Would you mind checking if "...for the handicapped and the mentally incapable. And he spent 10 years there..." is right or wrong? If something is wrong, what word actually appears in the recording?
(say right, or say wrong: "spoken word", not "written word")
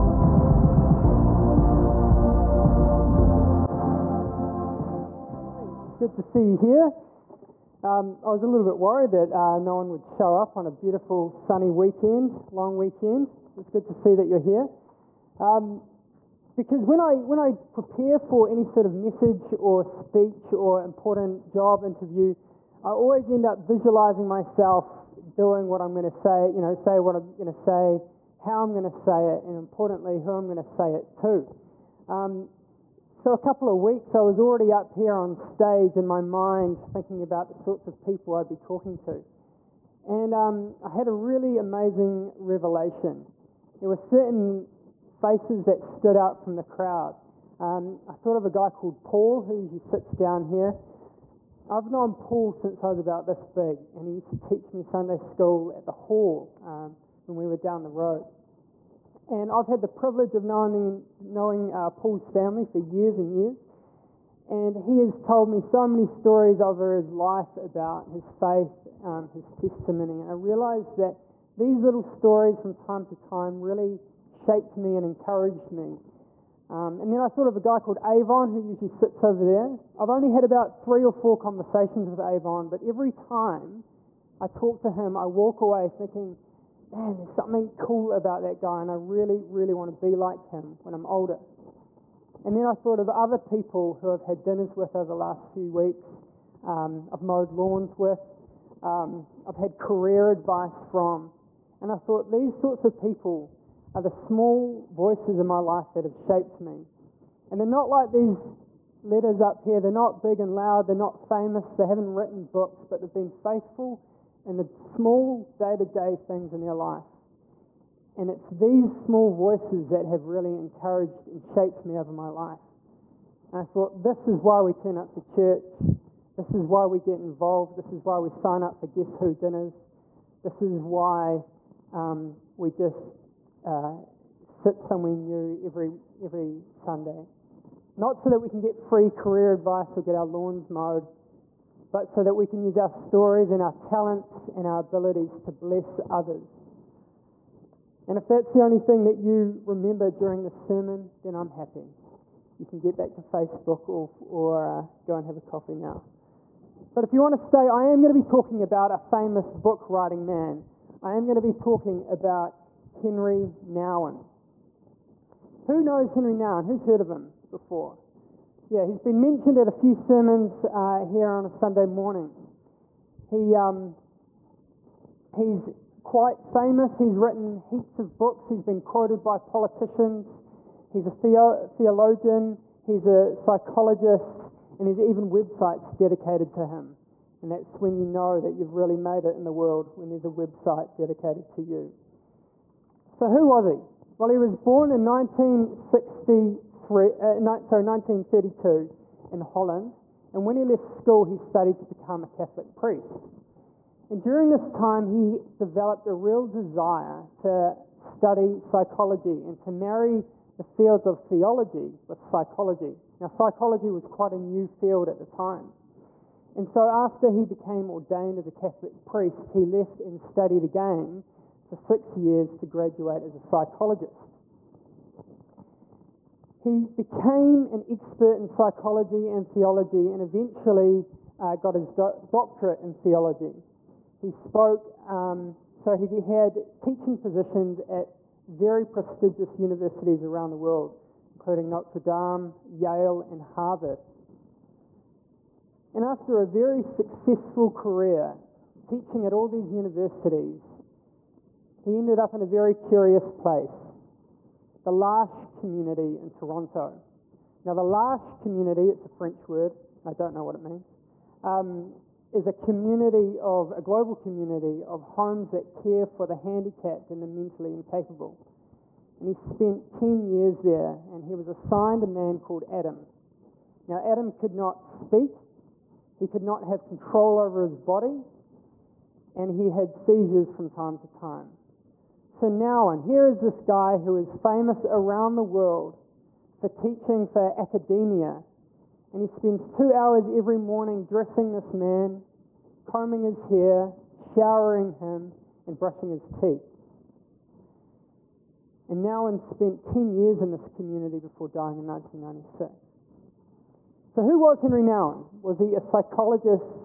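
right.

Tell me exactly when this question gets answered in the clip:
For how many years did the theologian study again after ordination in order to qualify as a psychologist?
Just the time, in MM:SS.
03:41.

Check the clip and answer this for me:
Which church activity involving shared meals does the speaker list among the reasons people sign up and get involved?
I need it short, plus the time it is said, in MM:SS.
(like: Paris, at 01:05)
Guess Who dinners, at 02:08.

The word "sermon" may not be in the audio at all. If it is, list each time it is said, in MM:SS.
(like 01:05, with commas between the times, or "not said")
02:30, 02:49.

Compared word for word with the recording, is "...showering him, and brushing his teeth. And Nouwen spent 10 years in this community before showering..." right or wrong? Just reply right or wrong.
wrong.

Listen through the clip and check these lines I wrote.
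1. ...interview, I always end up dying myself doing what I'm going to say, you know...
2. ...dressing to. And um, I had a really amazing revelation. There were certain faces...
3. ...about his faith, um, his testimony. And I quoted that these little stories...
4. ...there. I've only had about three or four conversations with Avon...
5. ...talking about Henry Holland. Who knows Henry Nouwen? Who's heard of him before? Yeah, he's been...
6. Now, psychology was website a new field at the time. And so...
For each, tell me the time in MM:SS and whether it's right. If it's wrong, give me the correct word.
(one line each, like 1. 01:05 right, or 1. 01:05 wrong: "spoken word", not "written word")
1. 00:21 wrong: "visualizing", not "dying"
2. 00:38 wrong: "talking", not "dressing"
3. 01:07 wrong: "realized", not "quoted"
4. 01:19 right
5. 02:41 wrong: "Nouwen", not "Holland"
6. 03:33 wrong: "quite", not "website".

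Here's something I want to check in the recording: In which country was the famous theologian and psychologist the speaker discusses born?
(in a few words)
Holland.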